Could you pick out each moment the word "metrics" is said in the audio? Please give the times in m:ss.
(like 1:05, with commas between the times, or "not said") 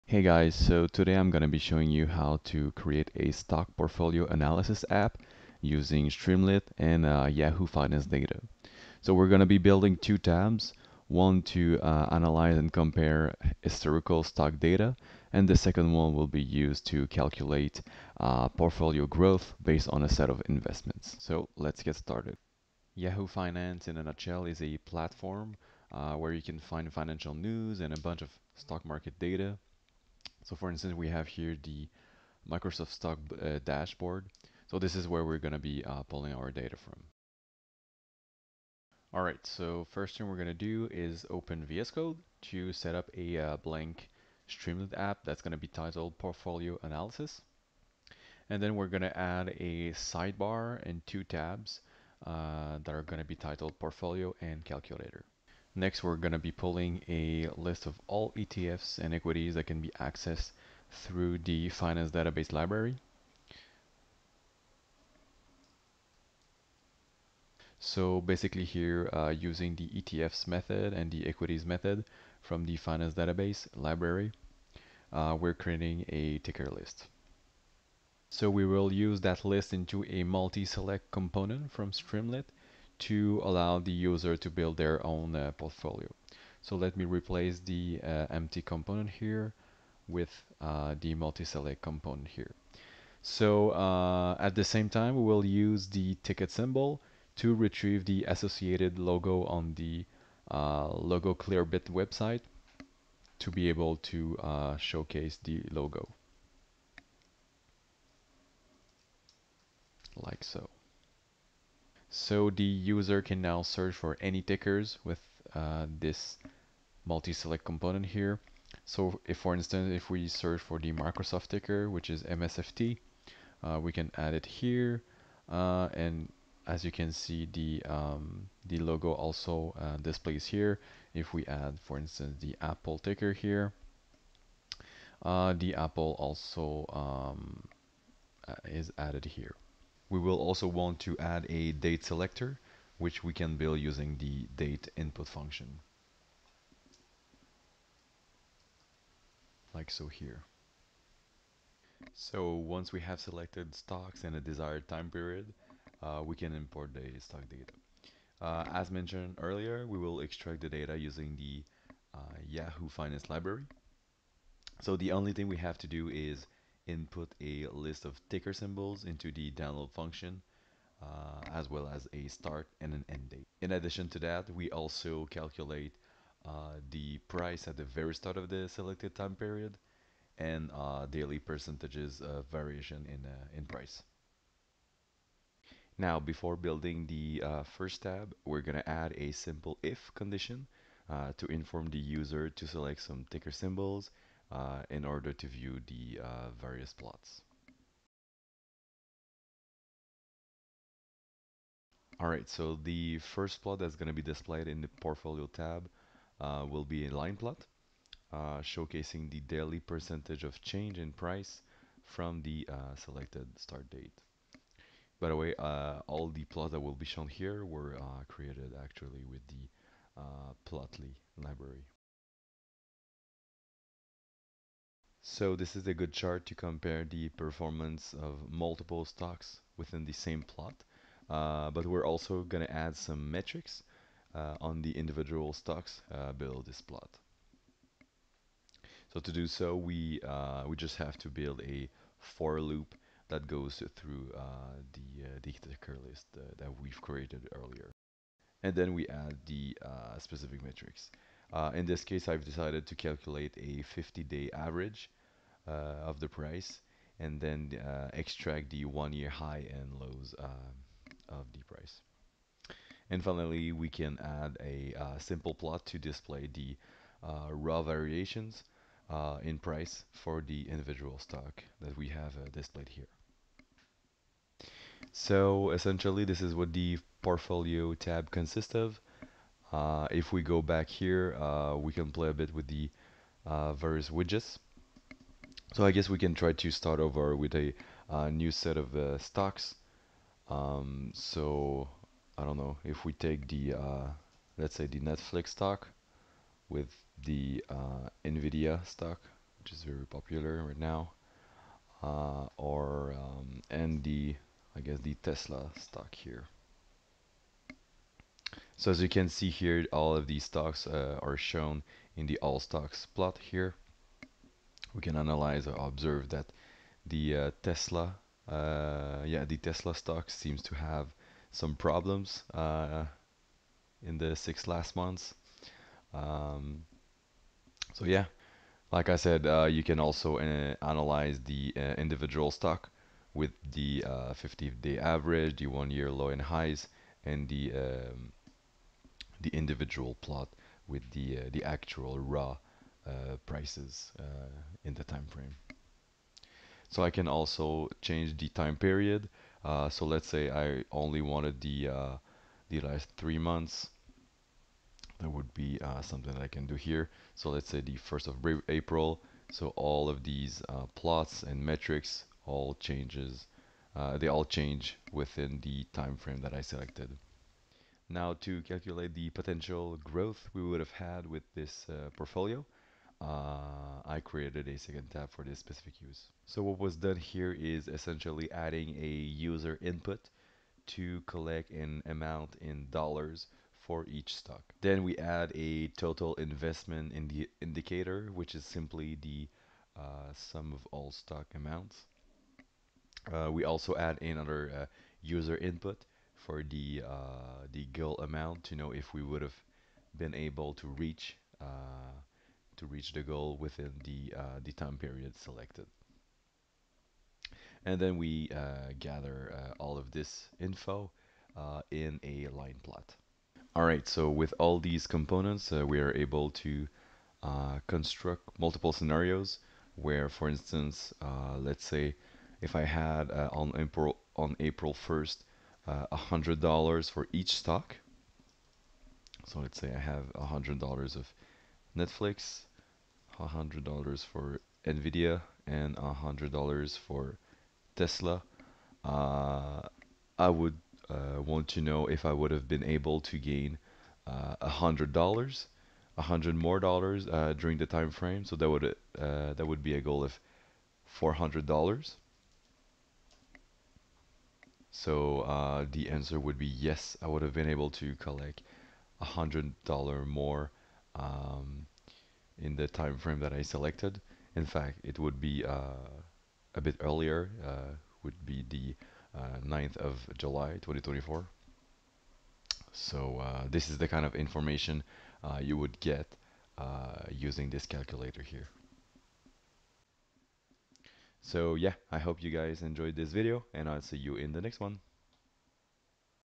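3:53, 4:10, 6:01.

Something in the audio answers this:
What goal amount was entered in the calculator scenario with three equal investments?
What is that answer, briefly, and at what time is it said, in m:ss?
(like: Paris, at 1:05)
$400, at 7:31.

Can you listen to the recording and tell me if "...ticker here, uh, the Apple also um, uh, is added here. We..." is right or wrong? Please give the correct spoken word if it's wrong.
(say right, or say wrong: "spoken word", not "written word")
right.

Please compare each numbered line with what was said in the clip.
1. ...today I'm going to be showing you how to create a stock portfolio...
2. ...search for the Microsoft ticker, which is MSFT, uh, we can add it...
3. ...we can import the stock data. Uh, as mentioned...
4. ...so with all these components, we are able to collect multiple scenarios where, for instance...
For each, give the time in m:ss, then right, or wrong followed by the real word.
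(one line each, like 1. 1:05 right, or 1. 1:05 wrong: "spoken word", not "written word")
1. 0:00 right
2. 2:00 right
3. 2:36 right
4. 6:54 wrong: "construct", not "collect".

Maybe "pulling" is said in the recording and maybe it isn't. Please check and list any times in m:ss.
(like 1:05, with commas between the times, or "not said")
0:36, 0:56.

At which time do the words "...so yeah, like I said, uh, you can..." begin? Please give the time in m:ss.
5:27.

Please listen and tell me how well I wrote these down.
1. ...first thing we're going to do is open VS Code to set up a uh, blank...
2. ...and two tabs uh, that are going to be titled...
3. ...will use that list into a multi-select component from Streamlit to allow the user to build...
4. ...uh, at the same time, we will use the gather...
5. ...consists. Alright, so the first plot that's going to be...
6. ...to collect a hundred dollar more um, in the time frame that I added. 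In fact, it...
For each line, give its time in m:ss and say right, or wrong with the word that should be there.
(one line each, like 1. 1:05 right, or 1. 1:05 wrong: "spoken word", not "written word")
1. 0:39 right
2. 0:50 right
3. 1:18 right
4. 1:33 wrong: "ticker", not "gather"
5. 3:16 wrong: "plots", not "consists"
6. 7:37 wrong: "selected", not "added".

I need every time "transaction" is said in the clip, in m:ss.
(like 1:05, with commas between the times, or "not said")
not said.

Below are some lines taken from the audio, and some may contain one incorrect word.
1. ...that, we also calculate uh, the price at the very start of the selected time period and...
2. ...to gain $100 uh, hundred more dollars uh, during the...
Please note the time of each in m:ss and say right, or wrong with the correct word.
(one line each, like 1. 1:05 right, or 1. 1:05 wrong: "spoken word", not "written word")
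1. 2:54 right
2. 7:23 right.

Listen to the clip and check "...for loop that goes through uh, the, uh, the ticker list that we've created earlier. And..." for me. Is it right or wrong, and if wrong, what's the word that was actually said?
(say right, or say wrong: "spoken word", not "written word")
right.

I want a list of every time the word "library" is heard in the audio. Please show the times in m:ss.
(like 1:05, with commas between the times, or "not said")
1:02, 1:13, 2:43, 3:41.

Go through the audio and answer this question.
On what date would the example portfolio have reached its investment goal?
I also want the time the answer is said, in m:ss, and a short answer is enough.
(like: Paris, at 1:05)
9 July 2024, at 7:49.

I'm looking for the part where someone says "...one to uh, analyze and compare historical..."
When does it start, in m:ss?
0:11.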